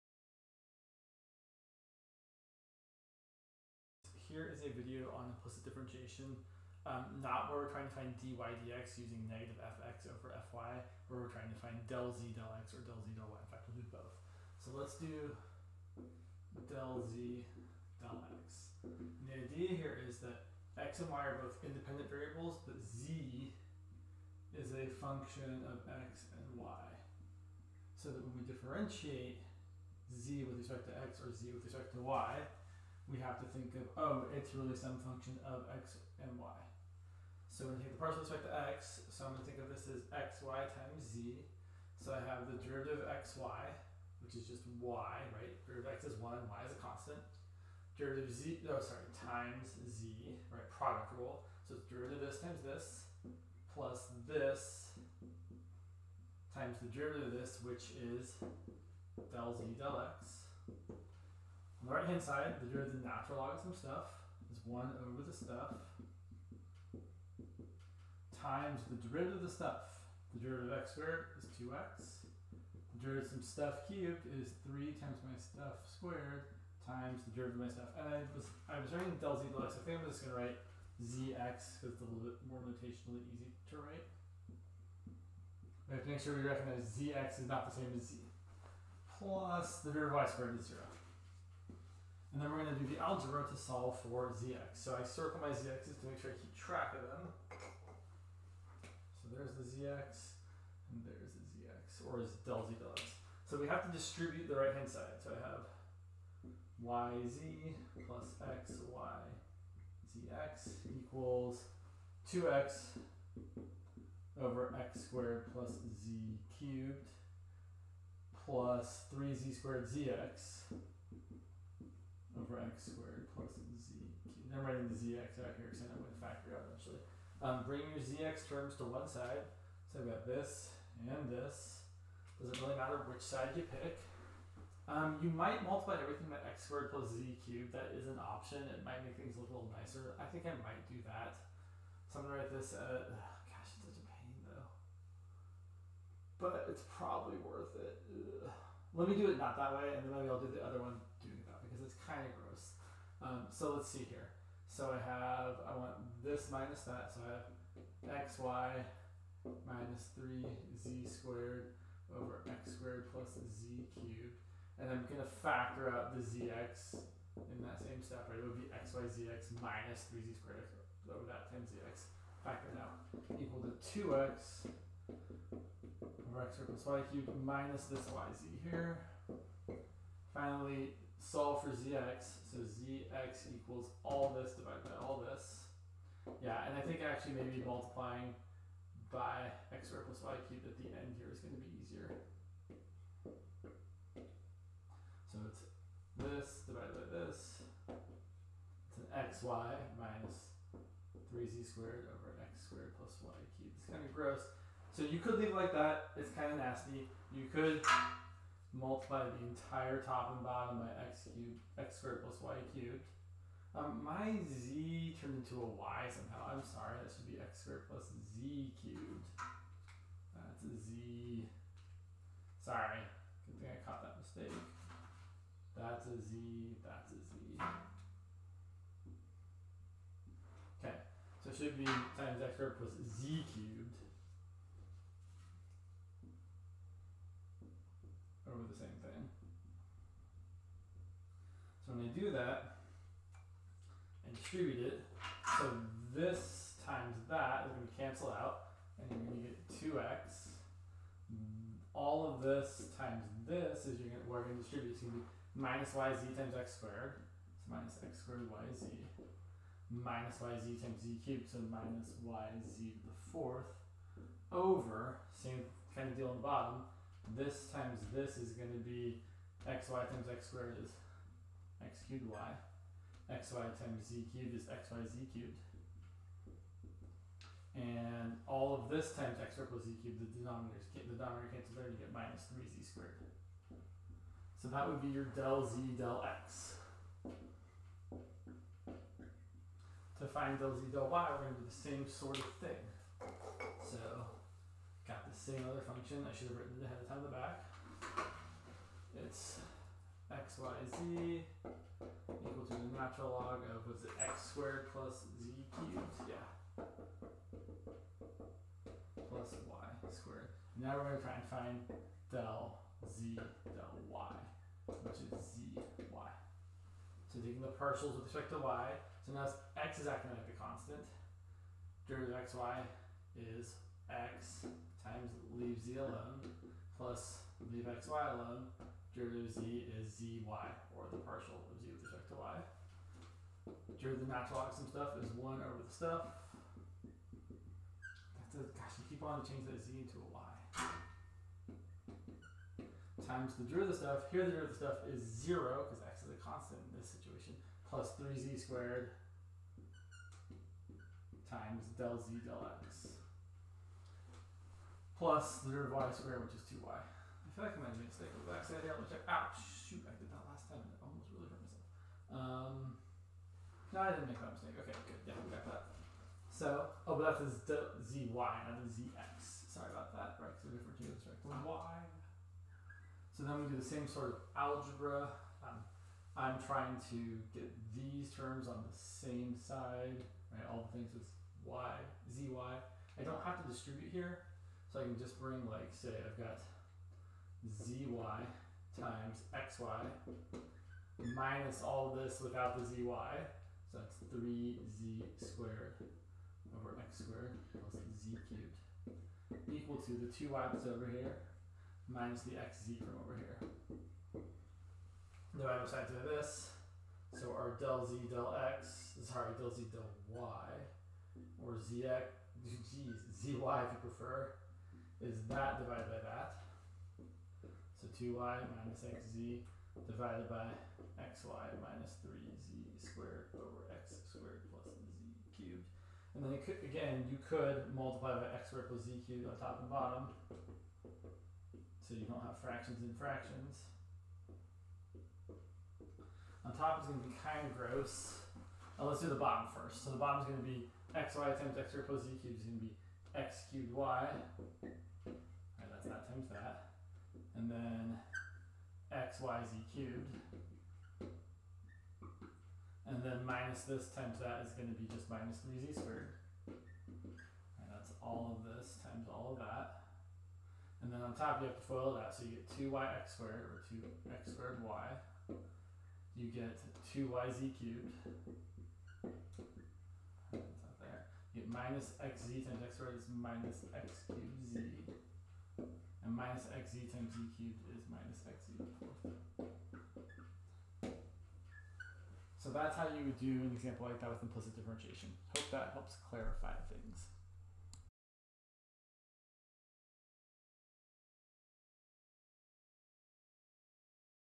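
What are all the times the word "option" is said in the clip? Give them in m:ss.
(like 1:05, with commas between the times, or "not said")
2:18.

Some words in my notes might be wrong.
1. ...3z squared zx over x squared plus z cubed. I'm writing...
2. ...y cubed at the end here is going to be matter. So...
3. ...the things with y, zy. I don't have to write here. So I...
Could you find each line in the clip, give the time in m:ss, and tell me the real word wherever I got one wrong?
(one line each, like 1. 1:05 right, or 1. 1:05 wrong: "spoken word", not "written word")
1. 1:59 right
2. 3:10 wrong: "easier", not "matter"
3. 6:20 wrong: "distribute", not "write".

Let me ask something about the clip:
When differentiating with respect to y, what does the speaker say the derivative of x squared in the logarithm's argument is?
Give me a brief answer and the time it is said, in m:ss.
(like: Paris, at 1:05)
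zero, at 5:44.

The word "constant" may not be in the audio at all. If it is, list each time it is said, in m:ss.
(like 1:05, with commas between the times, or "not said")
0:46, 5:20, 5:46.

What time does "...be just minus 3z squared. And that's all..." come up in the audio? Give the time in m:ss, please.
7:34.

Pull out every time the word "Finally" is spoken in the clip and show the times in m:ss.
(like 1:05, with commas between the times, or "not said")
3:00.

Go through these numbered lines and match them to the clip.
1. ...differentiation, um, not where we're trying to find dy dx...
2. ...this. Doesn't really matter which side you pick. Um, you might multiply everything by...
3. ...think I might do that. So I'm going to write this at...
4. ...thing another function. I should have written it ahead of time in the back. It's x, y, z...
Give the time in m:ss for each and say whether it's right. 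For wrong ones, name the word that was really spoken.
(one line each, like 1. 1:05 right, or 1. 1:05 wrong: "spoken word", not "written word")
1. 0:05 right
2. 2:11 right
3. 2:20 right
4. 4:52 right.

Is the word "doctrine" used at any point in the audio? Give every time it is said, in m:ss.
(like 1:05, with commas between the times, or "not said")
not said.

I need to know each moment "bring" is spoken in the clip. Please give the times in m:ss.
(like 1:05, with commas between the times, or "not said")
2:07, 6:25.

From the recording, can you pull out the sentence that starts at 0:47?
Derivative z, no, oh, sorry, times z, right, product rule.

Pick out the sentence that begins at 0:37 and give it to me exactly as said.
So when you take the partial respect to x, so I'm going to think of this as xy times z.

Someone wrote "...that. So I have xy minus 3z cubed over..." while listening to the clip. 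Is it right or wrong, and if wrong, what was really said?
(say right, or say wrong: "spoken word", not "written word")
wrong: "squared", not "cubed".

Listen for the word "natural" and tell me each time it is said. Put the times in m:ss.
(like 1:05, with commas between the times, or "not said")
1:03, 5:02, 5:34.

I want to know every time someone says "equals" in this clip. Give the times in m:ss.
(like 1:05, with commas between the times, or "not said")
1:50, 2:53, 3:03, 5:02, 6:39.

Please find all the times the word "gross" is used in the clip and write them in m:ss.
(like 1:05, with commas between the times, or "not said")
2:32, 3:24, 7:17.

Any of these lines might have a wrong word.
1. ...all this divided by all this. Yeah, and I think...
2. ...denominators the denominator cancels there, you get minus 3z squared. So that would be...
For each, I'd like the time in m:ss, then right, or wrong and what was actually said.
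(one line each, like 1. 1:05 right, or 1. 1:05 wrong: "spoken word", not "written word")
1. 3:04 right
2. 4:40 right.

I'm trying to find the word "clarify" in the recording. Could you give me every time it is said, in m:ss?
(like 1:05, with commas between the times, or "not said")
8:06.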